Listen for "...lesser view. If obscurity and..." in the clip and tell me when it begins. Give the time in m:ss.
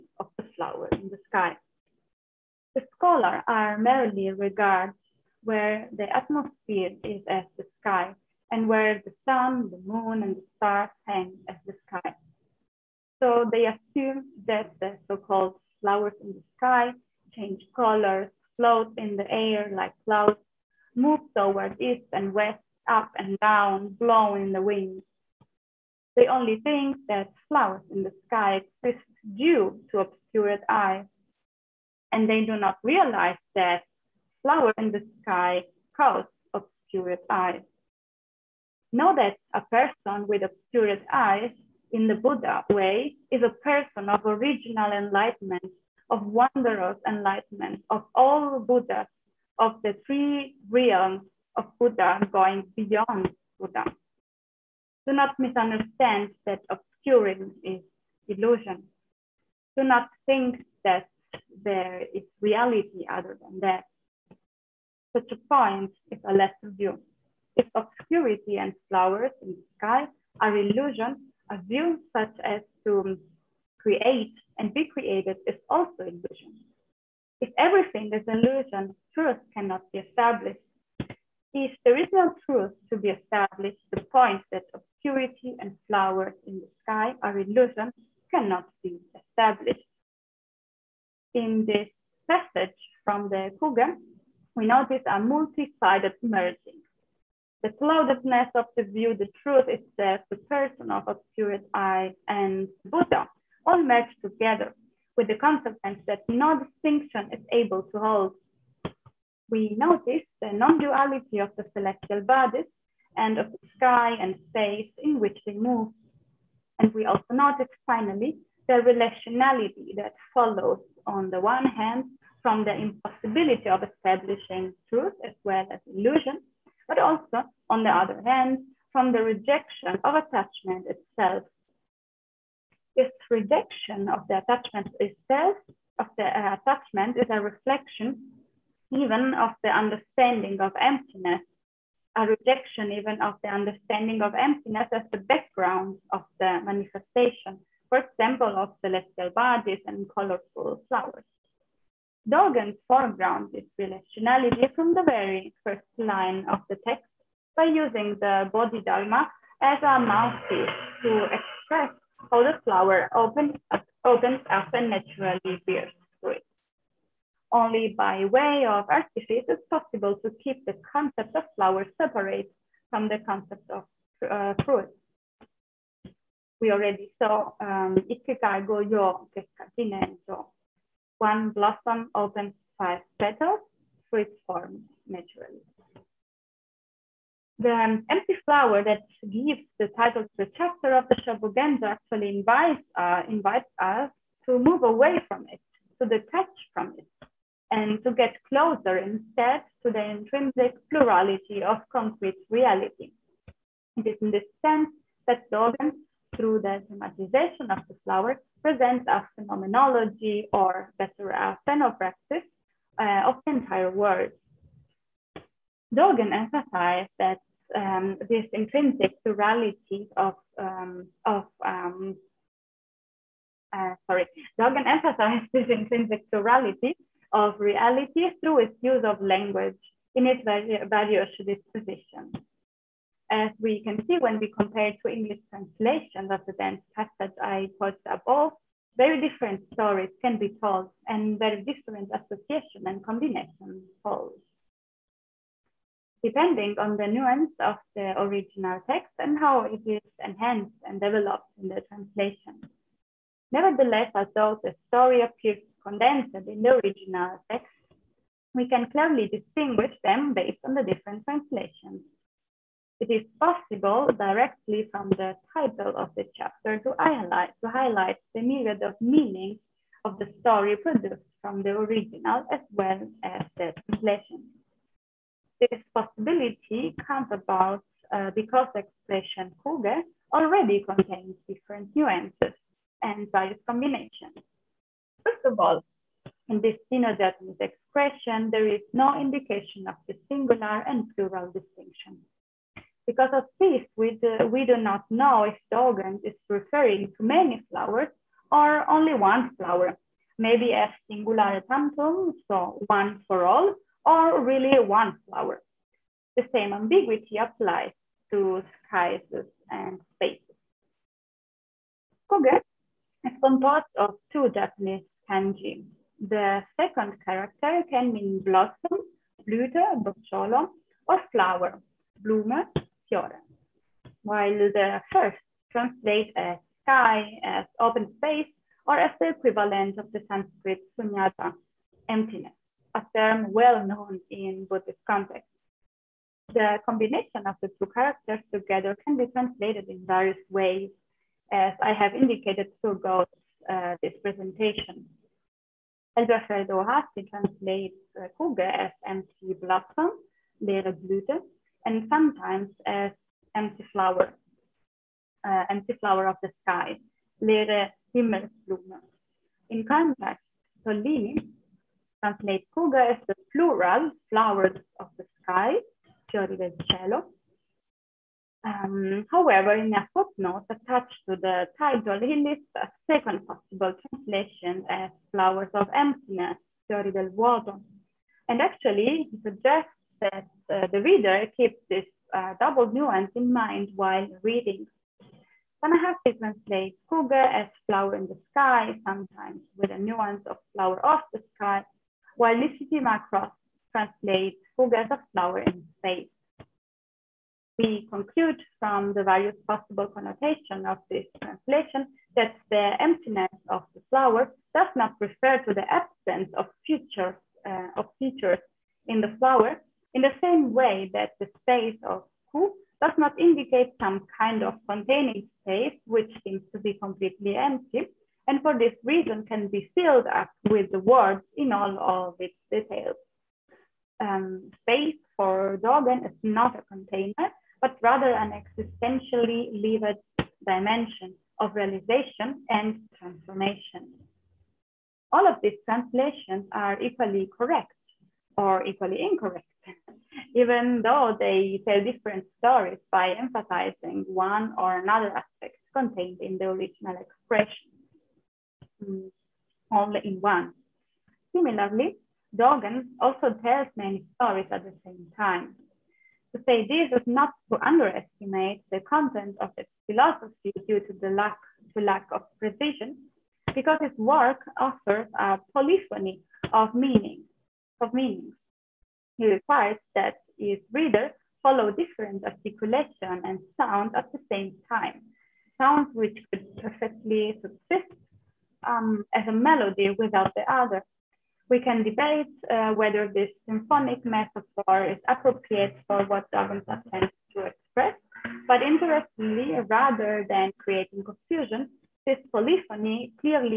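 1:06.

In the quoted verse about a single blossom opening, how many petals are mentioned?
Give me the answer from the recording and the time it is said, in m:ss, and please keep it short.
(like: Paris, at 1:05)
5, at 3:02.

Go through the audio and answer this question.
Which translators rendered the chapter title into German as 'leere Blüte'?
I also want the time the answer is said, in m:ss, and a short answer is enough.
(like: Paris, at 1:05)
Elberfeld and Ohashi, at 5:46.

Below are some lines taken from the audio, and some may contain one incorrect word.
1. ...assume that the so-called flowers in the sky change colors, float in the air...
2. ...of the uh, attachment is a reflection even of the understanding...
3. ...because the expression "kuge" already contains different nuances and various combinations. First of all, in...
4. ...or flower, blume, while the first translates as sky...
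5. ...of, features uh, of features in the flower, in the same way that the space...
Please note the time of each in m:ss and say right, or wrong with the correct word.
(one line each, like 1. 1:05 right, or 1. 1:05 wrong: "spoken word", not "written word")
1. 0:13 right
2. 2:15 right
3. 4:38 right
4. 5:21 right
5. 6:46 right.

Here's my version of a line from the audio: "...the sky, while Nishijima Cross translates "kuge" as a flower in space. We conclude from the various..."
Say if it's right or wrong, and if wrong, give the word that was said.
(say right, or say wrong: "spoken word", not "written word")
right.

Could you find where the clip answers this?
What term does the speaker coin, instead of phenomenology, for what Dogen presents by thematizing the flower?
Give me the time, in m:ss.
3:31.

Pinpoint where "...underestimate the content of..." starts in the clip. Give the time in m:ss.
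7:37.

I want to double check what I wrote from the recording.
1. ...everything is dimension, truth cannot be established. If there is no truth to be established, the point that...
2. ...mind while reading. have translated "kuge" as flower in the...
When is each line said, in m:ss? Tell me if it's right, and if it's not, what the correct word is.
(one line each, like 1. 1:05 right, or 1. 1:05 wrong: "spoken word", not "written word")
1. 1:17 wrong: "illusion", not "dimension"
2. 6:23 right.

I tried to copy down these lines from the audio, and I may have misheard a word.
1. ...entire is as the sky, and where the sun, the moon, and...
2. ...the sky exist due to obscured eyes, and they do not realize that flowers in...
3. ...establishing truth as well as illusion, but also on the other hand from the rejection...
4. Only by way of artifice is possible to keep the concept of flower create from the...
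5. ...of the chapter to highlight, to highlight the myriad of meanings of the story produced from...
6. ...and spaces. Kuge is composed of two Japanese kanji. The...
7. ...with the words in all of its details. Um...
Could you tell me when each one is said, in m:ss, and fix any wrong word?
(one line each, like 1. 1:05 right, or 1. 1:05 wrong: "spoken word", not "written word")
1. 0:06 wrong: "atmosphere", not "entire"
2. 0:28 right
3. 2:03 right
4. 2:47 wrong: "separate", not "create"
5. 4:25 right
6. 5:09 right
7. 7:00 right.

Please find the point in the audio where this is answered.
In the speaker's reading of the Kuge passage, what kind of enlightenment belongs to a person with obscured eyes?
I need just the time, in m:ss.
0:44.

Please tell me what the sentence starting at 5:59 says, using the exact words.
In context, Tollini translates Kuge as the plural, flowers of the sky, fiori del cielo.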